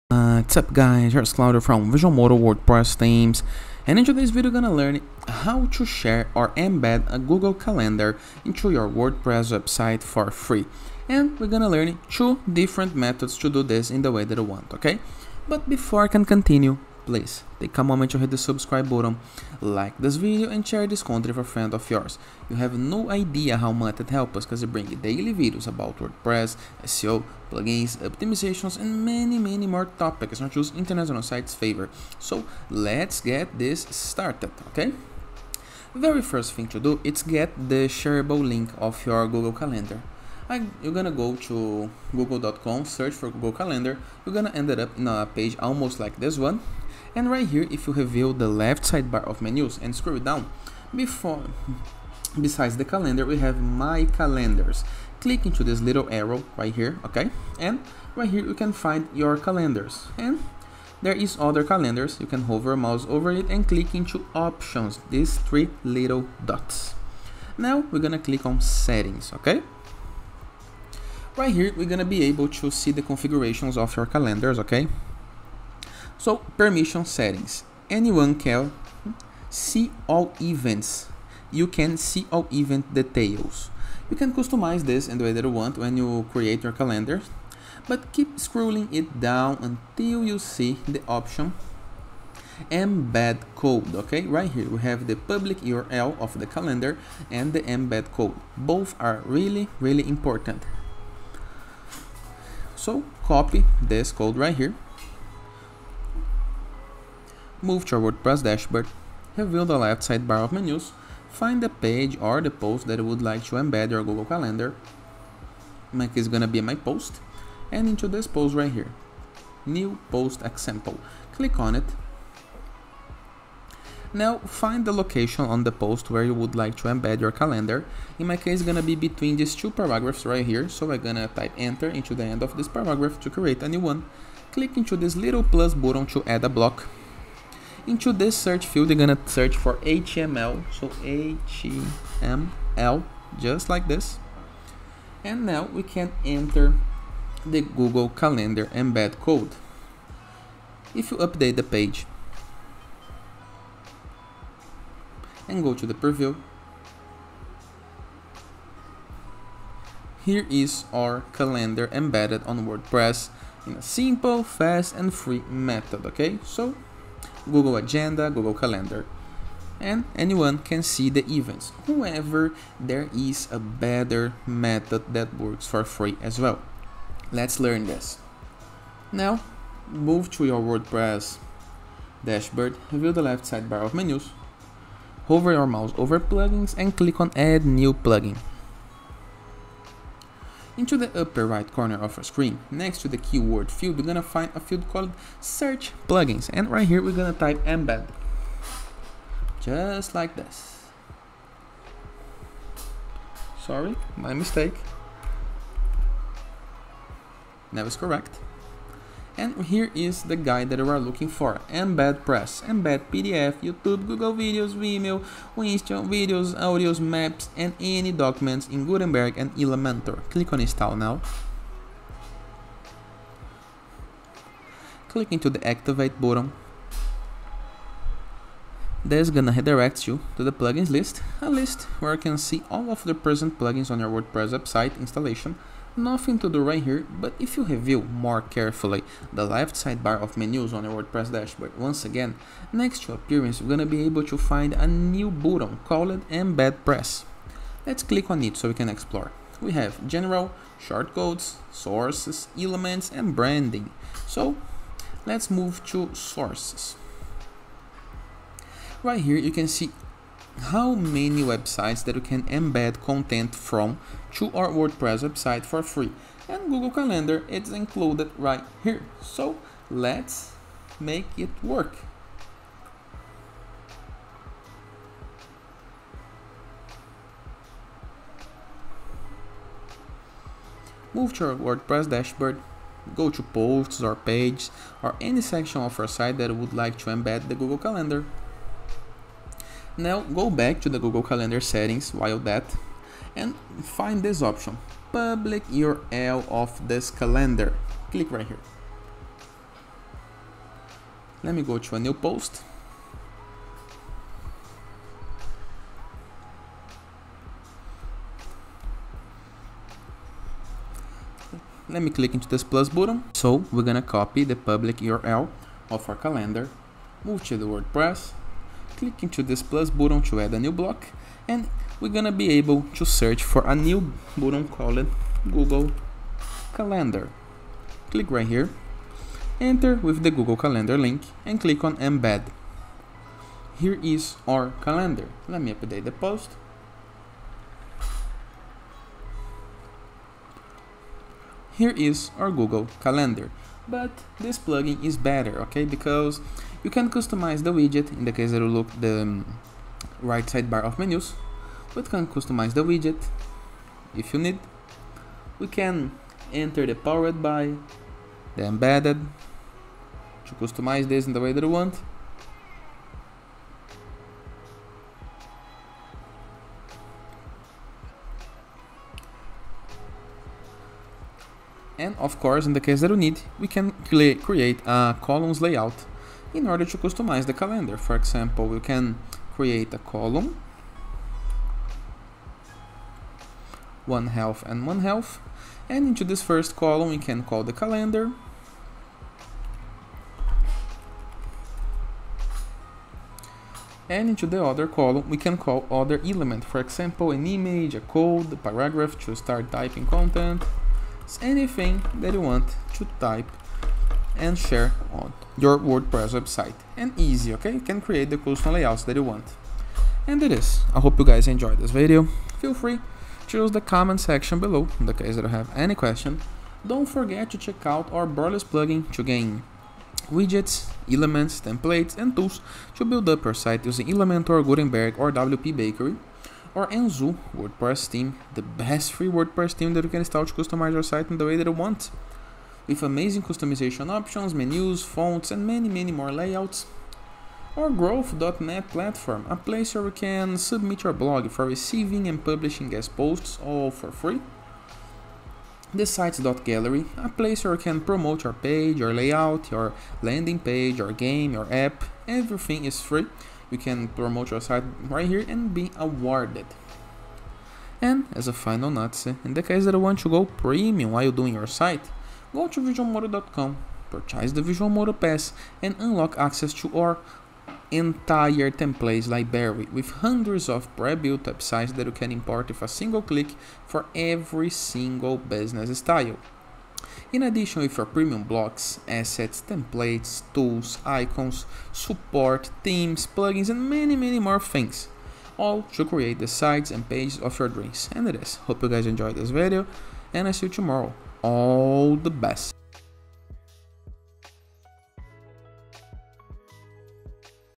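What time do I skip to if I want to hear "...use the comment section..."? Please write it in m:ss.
6:53.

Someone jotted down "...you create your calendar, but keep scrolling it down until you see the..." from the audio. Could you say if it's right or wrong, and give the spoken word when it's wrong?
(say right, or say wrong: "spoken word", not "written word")
right.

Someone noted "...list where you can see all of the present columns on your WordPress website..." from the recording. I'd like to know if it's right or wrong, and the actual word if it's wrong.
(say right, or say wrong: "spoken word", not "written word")
wrong: "plugins", not "columns".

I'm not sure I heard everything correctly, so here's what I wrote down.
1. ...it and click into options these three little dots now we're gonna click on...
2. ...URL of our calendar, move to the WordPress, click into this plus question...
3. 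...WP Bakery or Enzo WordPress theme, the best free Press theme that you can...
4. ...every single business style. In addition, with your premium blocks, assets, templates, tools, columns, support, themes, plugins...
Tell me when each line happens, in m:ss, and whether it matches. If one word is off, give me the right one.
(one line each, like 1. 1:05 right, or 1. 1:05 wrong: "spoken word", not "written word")
1. 1:03 right
2. 5:14 wrong: "button", not "question"
3. 7:05 wrong: "WordPress", not "Press"
4. 7:54 wrong: "icons", not "columns".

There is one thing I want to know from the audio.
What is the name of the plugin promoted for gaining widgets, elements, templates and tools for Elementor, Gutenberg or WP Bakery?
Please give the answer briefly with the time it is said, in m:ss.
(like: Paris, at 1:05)
Borderless, at 6:58.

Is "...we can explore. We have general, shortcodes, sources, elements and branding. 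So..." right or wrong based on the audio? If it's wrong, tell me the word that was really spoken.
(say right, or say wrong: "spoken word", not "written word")
right.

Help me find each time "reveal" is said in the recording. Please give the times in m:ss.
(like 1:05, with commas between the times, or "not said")
0:47, 1:49.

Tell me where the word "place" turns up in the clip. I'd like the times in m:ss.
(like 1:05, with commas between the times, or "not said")
7:19, 7:27.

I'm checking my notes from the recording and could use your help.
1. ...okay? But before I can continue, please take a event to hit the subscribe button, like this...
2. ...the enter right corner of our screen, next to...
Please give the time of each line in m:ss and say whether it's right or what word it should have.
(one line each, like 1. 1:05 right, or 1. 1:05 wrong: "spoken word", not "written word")
1. 0:14 wrong: "moment", not "event"
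2. 3:10 wrong: "upper", not "enter".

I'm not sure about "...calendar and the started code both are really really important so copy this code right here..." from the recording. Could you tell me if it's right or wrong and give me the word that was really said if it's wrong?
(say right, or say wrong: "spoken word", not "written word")
wrong: "embed", not "started".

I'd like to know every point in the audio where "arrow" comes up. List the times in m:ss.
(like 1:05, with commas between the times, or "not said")
0:56.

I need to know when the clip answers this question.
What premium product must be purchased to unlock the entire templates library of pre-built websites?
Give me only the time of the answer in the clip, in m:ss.
7:44.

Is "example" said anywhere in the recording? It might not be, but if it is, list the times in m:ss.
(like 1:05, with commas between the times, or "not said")
2:00, 6:18, 6:36.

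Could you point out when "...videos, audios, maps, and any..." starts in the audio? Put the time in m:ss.
3:36.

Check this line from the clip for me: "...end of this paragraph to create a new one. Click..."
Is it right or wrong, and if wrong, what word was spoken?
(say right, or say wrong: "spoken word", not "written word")
right.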